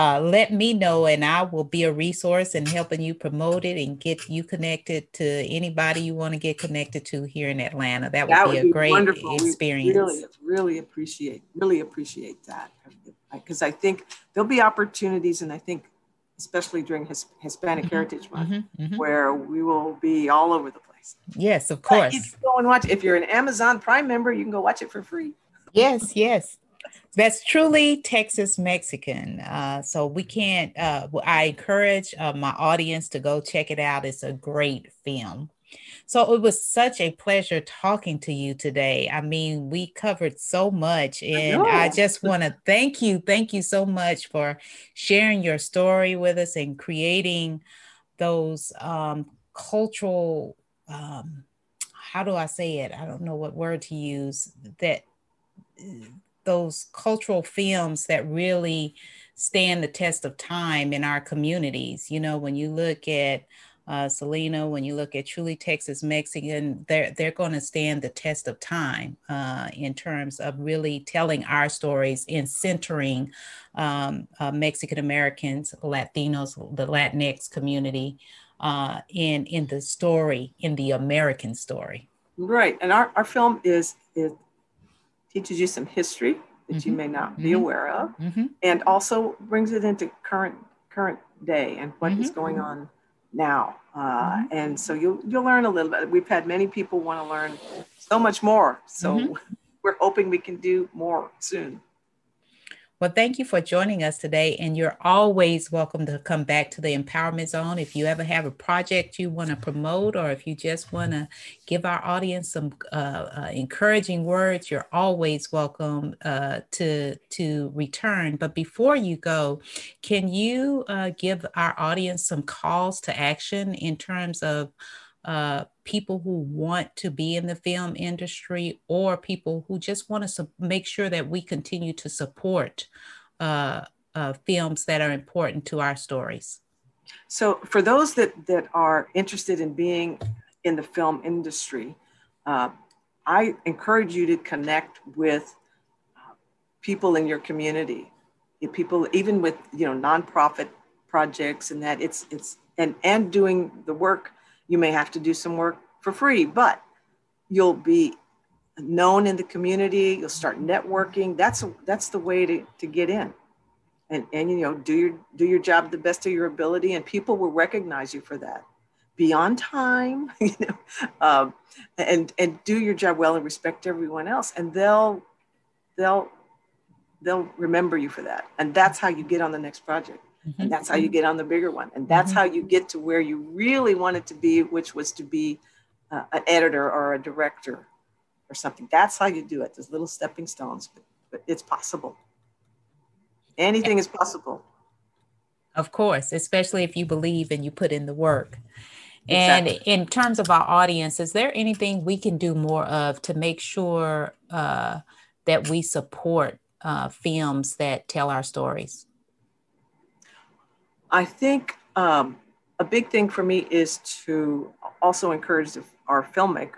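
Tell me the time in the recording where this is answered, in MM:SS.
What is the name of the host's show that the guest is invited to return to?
01:46.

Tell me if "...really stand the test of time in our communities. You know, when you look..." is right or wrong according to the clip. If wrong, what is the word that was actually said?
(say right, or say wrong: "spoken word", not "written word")
right.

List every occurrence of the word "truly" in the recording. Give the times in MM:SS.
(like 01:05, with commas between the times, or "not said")
00:27, 01:05.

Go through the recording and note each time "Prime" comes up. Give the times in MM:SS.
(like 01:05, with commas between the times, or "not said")
00:23.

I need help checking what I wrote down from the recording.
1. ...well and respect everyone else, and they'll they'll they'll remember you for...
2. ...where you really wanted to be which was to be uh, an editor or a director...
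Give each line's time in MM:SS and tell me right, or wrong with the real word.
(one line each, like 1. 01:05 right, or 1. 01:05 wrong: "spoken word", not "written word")
1. 02:53 right
2. 03:02 right.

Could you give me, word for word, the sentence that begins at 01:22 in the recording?
Right, and our, our film is it teaches you some history that mm-hmm.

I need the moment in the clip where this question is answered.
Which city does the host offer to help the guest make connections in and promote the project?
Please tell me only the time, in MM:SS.
00:07.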